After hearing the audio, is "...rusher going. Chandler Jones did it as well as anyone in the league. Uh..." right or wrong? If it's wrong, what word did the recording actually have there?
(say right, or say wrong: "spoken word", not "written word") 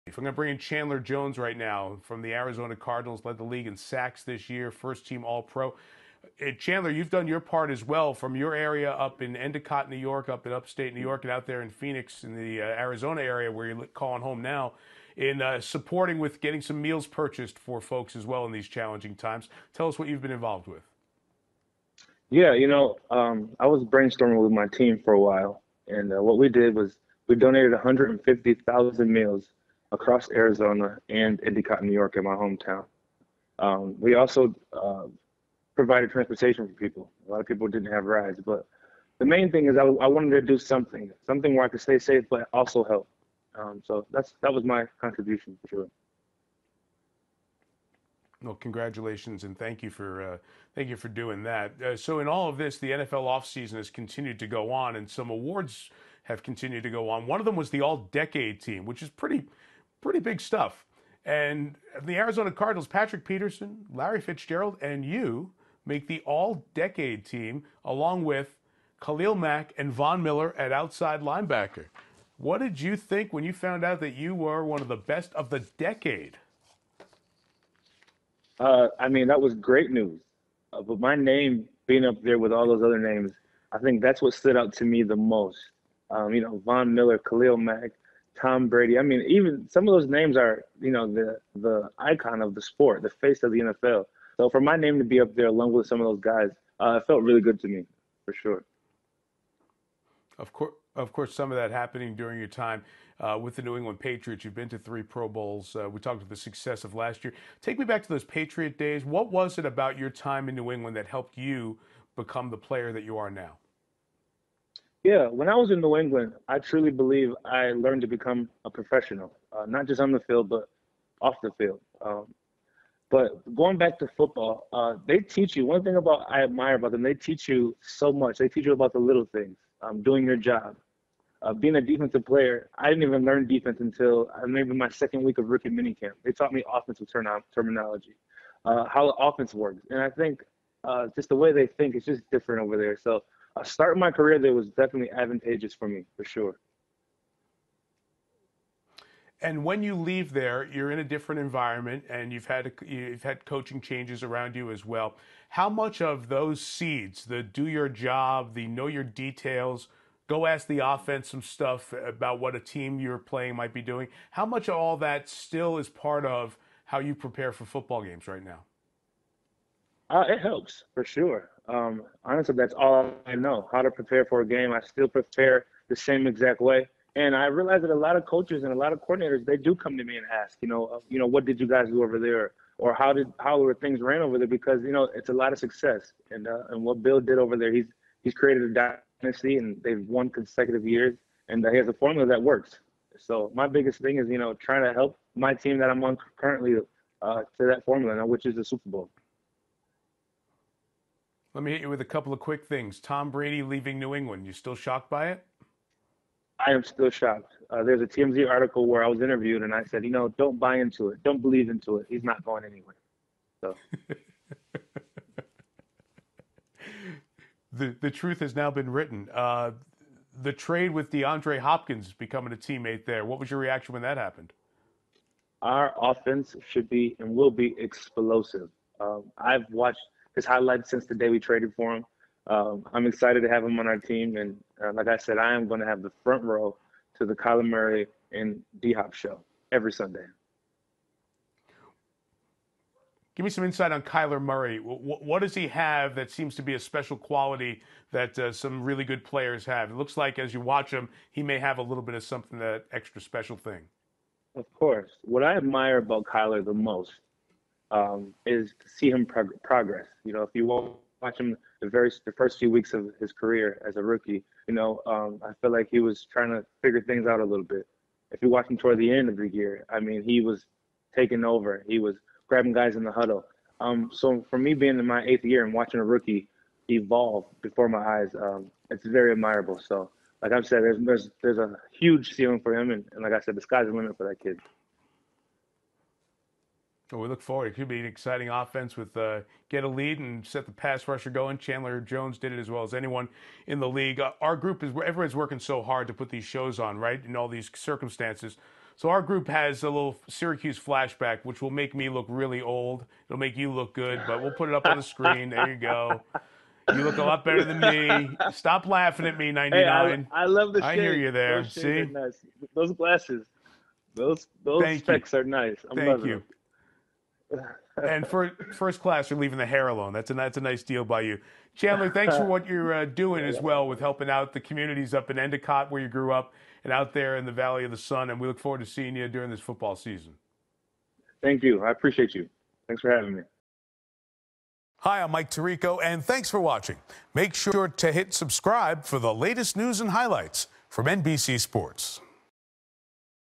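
right.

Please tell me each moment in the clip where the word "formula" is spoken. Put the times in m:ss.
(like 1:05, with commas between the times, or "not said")
3:11, 3:17.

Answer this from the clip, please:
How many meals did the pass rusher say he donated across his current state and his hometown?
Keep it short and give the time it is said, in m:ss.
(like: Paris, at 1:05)
150,000, at 0:27.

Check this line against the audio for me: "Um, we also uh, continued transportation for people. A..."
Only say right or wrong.
wrong.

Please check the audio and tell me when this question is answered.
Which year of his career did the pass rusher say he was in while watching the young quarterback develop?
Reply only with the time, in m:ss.
4:35.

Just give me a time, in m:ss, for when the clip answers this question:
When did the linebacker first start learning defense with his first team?
2:14.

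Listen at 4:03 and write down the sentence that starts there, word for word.
Give me some insight on Kyler Murray.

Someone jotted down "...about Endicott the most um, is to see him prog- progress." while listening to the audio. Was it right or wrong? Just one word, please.
wrong.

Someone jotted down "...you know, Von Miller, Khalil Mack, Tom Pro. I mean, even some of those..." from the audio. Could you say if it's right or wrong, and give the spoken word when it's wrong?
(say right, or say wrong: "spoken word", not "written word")
wrong: "Brady", not "Pro".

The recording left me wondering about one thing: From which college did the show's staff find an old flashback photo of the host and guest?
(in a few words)
Syracuse.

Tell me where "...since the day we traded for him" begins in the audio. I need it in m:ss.
3:50.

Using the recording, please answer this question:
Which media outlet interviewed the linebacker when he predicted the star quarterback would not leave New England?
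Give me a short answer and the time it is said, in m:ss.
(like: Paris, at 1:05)
TMZ, at 3:28.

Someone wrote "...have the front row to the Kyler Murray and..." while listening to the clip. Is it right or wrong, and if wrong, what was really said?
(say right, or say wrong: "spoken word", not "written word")
right.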